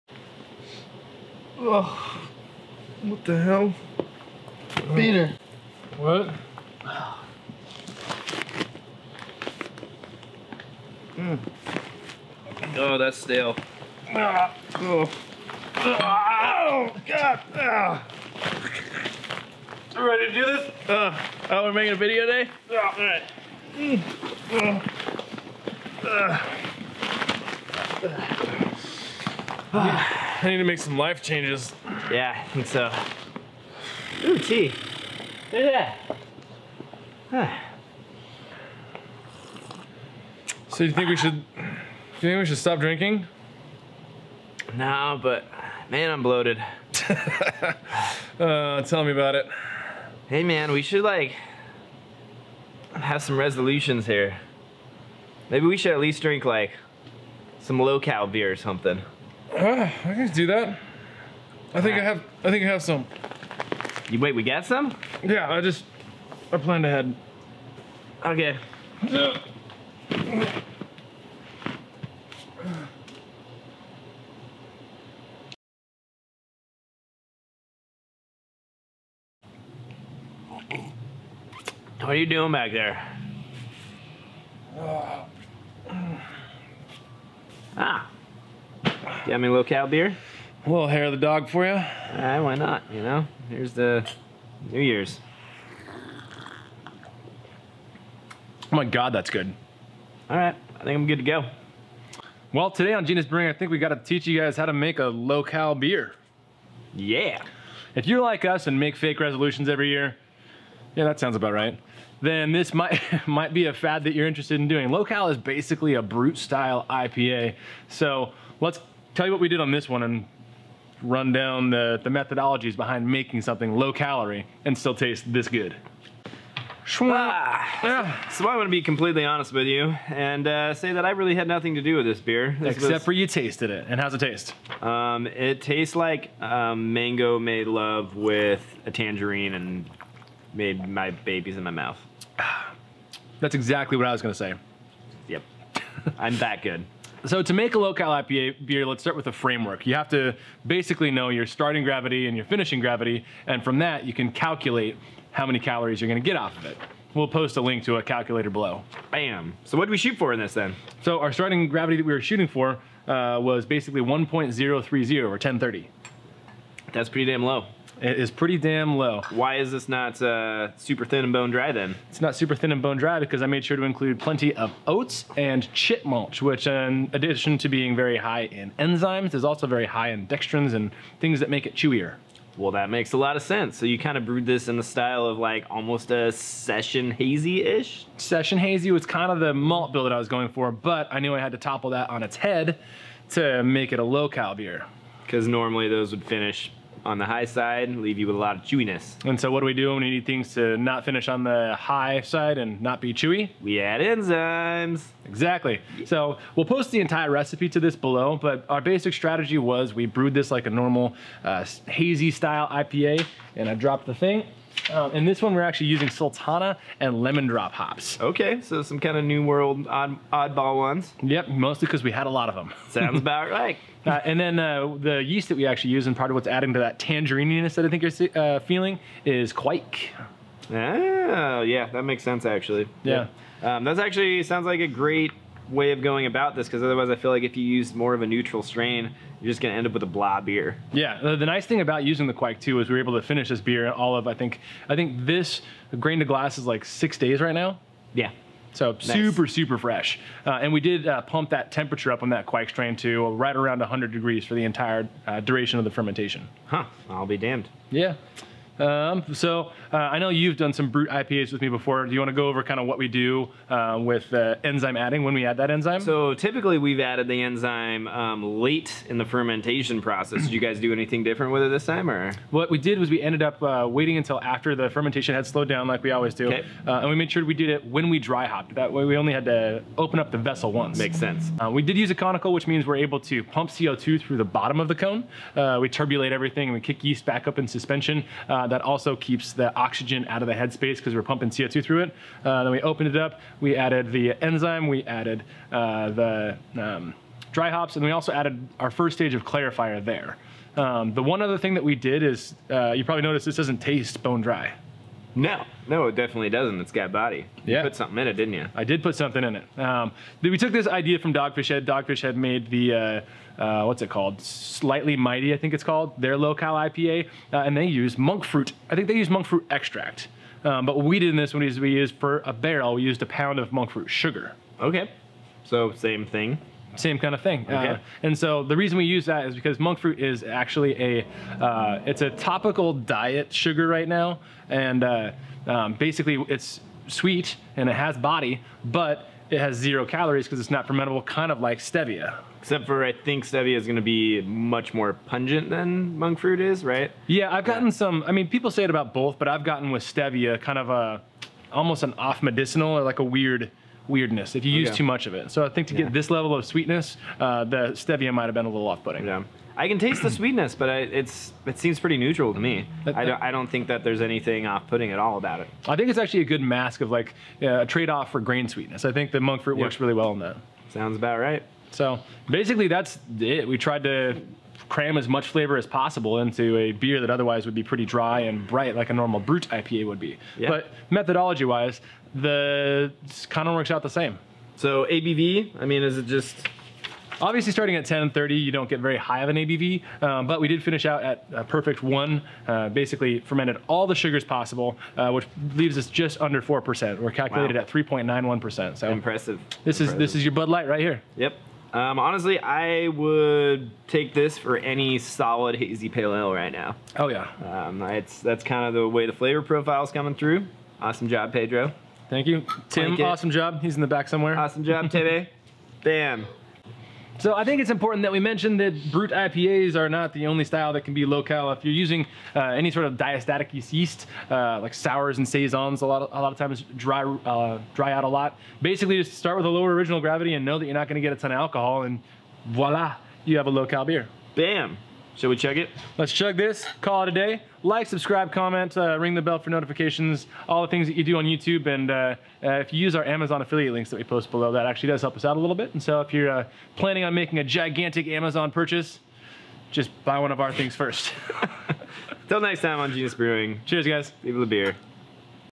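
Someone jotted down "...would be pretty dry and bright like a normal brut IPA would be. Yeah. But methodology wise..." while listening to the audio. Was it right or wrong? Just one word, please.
right.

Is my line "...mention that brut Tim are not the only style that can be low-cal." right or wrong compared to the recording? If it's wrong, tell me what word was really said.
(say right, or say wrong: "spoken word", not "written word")
wrong: "IPAs", not "Tim".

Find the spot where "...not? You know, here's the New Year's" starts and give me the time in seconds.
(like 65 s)
92 s.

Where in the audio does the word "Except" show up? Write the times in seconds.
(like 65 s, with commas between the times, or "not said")
132 s, 342 s.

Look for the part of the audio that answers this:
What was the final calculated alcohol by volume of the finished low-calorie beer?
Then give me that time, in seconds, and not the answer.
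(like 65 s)
397 s.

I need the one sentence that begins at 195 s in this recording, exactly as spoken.
Because normally those would finish on the high side, leave you with a lot of chewiness.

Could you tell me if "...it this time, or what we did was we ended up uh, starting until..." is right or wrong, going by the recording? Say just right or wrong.
wrong.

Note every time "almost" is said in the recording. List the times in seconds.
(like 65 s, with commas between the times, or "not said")
185 s, 351 s.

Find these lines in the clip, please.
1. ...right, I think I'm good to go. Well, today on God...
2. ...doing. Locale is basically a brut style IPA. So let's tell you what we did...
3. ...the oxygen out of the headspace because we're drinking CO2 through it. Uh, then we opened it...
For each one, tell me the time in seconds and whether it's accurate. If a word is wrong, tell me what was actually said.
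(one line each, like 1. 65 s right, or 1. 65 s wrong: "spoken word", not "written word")
1. 100 s wrong: "Genus", not "God"
2. 114 s right
3. 289 s wrong: "pumping", not "drinking".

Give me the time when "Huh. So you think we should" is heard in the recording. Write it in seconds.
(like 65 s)
37 s.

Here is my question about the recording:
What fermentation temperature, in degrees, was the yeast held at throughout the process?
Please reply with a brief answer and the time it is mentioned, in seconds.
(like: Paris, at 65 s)
100 degrees, at 253 s.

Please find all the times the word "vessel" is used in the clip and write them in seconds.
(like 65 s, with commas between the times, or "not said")
280 s.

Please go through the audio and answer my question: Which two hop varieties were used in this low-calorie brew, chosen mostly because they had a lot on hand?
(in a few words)
Sultana and Lemon Drop.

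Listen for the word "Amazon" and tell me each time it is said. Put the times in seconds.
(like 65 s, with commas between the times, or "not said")
443 s, 448 s.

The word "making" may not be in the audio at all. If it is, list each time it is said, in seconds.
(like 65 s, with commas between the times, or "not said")
21 s, 123 s, 447 s.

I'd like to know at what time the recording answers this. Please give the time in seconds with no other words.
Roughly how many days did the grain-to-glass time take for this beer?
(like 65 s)
246 s.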